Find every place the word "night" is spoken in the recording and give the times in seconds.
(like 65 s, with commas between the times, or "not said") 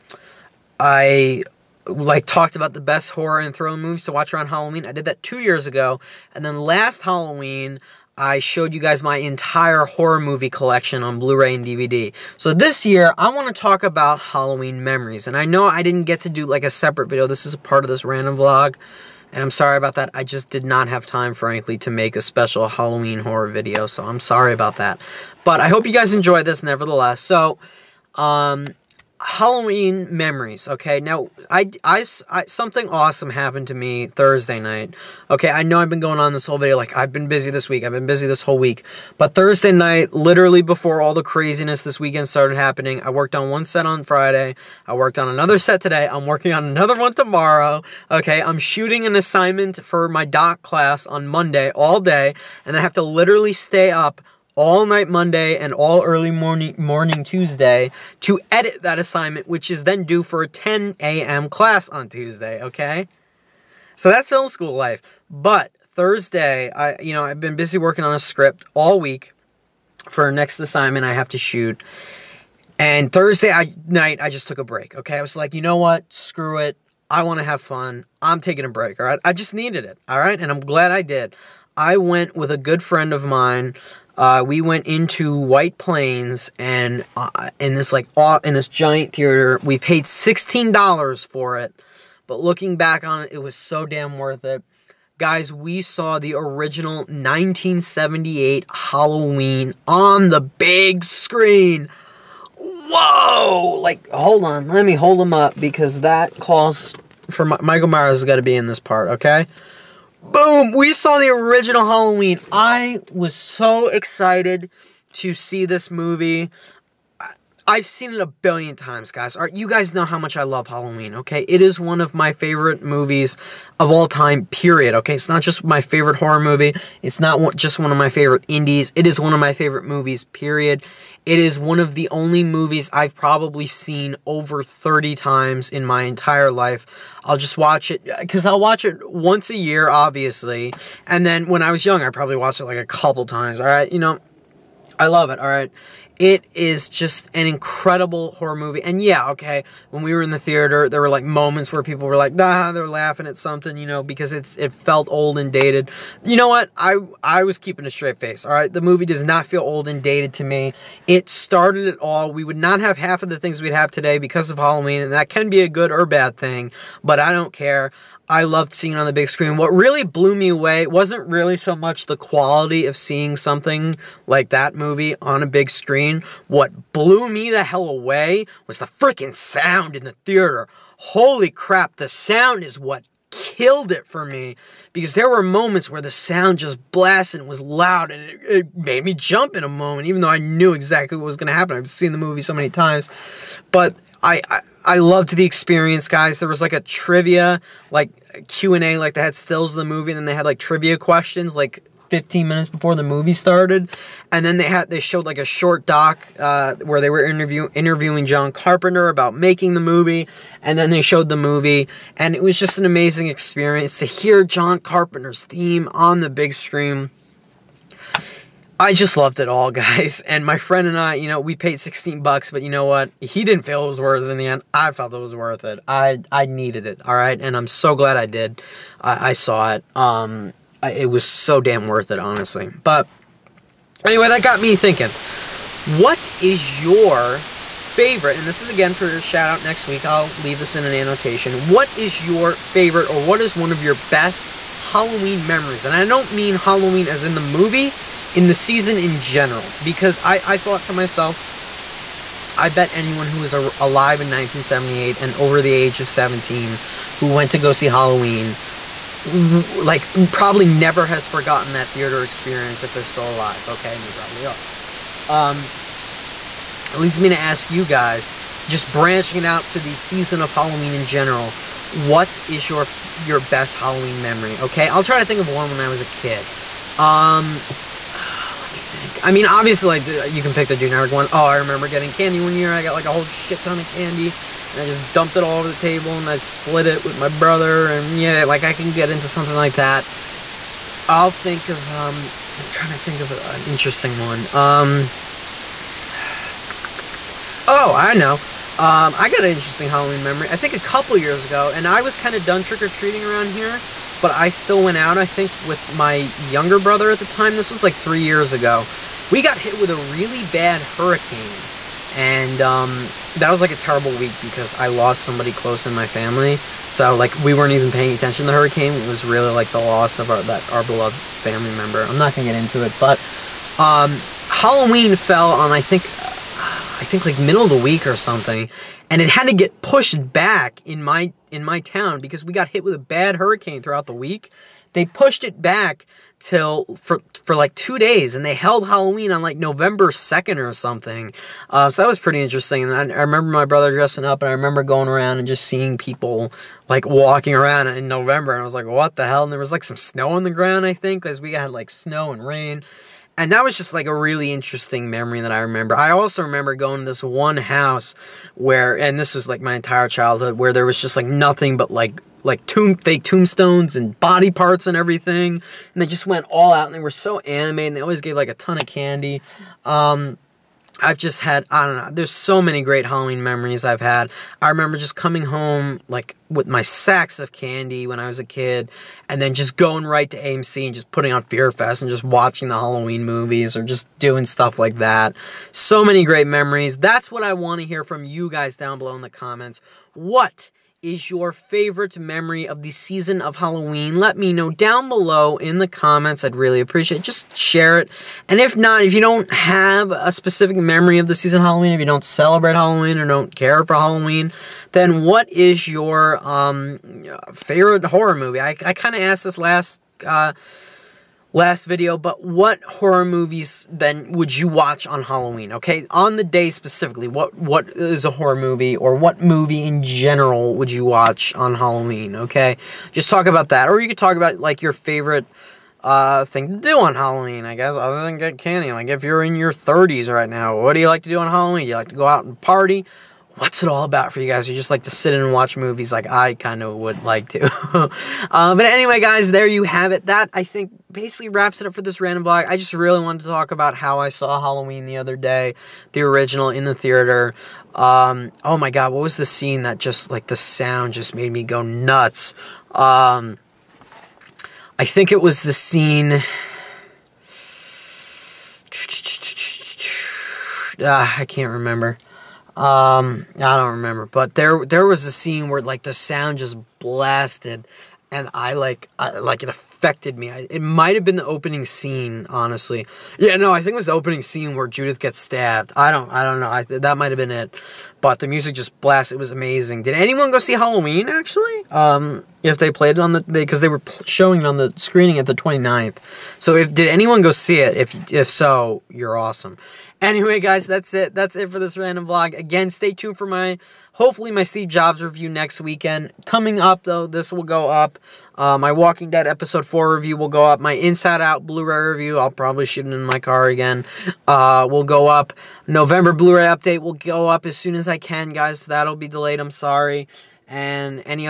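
34 s, 39 s, 54 s, 73 s.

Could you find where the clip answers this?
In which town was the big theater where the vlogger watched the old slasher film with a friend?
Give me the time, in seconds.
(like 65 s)
85 s.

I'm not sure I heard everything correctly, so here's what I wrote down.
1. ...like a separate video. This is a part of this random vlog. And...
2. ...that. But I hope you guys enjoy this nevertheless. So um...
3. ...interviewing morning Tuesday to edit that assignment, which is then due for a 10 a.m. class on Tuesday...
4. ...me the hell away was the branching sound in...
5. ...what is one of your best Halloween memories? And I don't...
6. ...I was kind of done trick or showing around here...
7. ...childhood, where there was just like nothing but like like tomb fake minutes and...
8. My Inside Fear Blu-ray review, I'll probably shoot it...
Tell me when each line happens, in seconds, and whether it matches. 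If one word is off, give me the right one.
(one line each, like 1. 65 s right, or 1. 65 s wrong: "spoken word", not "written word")
1. 16 s right
2. 24 s right
3. 56 s wrong: "morning", not "interviewing"
4. 177 s wrong: "freaking", not "branching"
5. 243 s right
6. 301 s wrong: "treating", not "showing"
7. 360 s wrong: "tombstones", not "minutes"
8. 500 s wrong: "Out", not "Fear".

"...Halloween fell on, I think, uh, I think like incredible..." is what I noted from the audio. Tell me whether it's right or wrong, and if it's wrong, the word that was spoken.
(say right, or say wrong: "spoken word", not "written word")
wrong: "middle", not "incredible".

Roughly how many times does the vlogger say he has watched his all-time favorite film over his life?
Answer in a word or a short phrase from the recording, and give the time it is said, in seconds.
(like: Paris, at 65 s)
over 30, at 134 s.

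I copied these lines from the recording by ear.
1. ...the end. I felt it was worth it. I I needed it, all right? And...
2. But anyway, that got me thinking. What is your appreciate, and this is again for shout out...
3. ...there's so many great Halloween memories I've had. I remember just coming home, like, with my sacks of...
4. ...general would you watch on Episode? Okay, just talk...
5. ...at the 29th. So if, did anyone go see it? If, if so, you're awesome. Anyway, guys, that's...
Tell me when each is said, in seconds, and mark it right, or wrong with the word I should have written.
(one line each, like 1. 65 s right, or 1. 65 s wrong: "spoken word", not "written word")
1. 224 s right
2. 232 s wrong: "favorite", not "appreciate"
3. 372 s right
4. 420 s wrong: "Halloween", not "Episode"
5. 485 s right.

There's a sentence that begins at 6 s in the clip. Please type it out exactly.
And then last Halloween, I showed you guys my entire horror movie collection on Blu-ray and DVD.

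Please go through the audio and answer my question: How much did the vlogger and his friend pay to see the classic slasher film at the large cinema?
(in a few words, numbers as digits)
$16.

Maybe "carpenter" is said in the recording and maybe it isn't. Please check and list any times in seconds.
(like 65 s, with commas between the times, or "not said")
208 s, 214 s.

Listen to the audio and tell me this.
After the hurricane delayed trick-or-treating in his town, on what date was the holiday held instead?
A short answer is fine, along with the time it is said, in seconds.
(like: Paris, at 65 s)
November 2, at 339 s.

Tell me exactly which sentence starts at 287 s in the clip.
And yeah, like I can get into something like that.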